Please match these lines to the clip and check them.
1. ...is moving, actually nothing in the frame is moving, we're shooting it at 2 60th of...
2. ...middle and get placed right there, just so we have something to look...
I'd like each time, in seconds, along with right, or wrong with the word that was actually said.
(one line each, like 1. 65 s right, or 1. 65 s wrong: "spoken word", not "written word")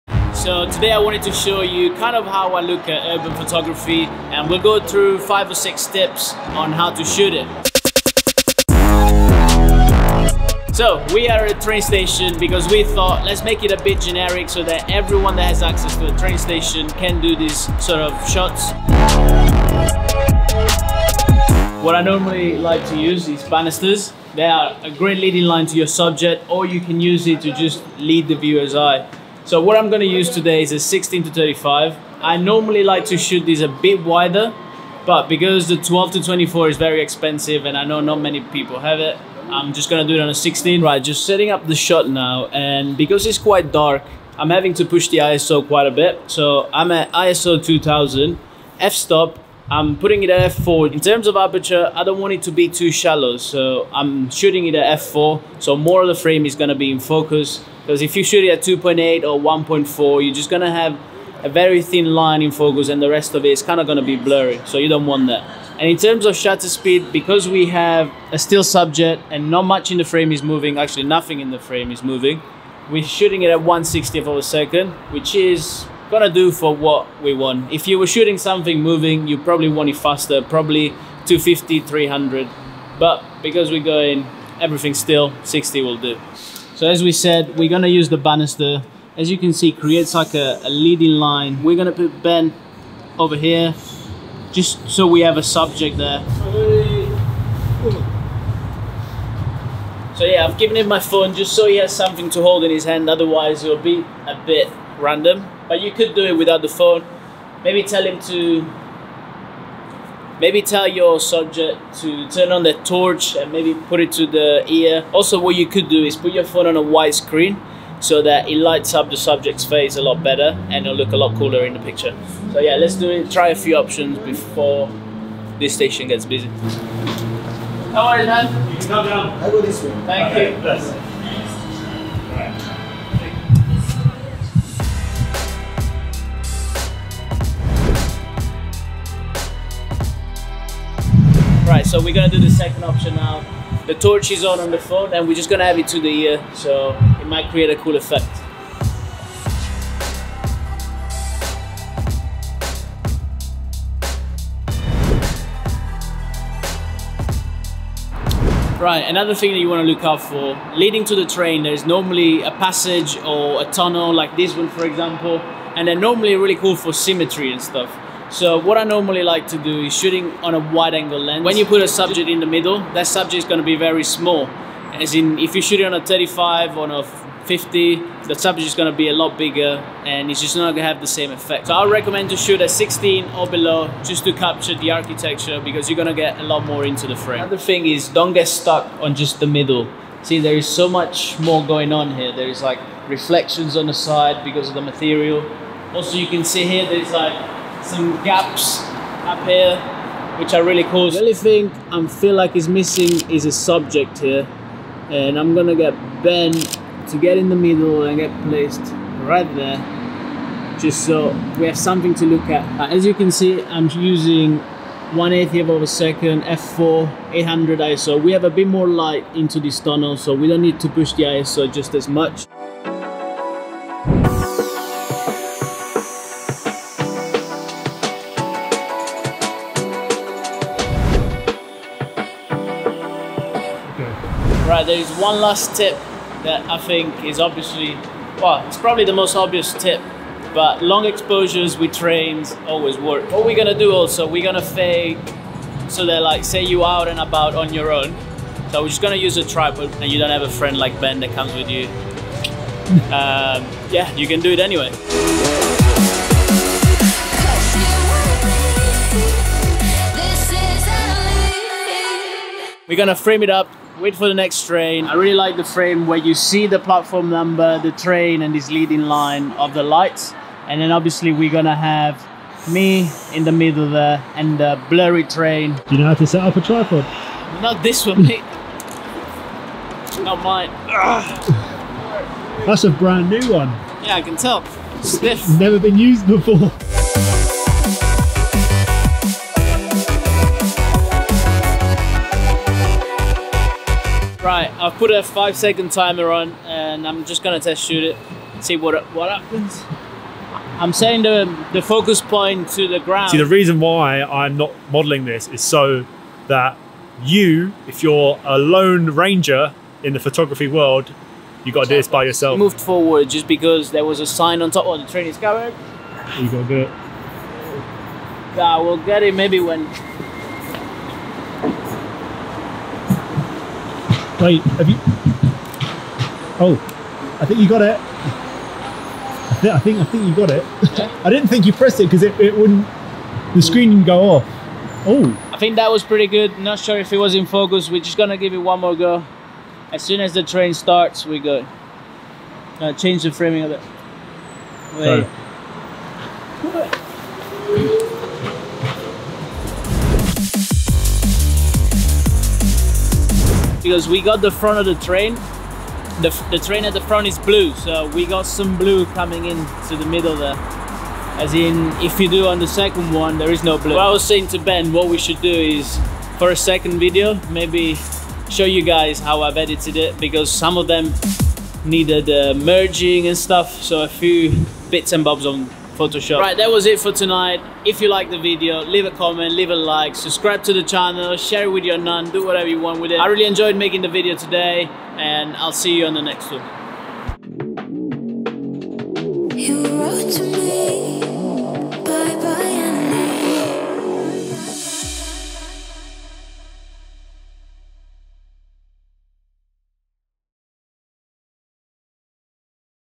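1. 70 s wrong: "1", not "2"
2. 207 s right.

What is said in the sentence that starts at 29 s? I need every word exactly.
So what I'm going to use today is a 16 to 35.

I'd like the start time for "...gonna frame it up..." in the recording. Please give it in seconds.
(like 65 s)
262 s.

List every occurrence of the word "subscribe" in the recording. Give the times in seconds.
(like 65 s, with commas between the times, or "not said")
380 s.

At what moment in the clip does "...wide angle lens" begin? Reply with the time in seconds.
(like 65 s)
170 s.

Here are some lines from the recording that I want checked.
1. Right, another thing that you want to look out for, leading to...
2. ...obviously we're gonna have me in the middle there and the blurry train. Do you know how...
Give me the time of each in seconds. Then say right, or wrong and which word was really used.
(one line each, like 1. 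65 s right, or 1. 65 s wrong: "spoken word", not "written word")
1. 158 s right
2. 270 s right.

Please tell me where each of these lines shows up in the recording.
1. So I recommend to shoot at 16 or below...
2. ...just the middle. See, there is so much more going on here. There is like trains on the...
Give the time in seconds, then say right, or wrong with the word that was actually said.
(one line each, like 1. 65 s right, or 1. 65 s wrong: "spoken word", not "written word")
1. 181 s right
2. 189 s wrong: "reflections", not "trains".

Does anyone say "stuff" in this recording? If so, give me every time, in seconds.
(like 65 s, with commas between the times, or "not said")
167 s, 373 s.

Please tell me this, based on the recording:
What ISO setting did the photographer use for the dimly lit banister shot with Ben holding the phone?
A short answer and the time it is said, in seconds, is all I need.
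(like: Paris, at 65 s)
2000, at 47 s.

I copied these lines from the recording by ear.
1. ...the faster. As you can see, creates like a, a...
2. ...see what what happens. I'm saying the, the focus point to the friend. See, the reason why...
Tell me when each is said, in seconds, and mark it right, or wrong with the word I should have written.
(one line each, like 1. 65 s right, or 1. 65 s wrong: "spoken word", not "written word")
1. 88 s wrong: "banister", not "faster"
2. 298 s wrong: "ground", not "friend".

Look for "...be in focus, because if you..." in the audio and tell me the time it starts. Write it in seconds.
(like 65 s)
56 s.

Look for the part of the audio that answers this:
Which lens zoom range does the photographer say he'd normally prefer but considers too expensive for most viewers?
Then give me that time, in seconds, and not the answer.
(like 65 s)
35 s.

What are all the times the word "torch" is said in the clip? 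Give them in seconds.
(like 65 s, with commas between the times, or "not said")
112 s, 143 s.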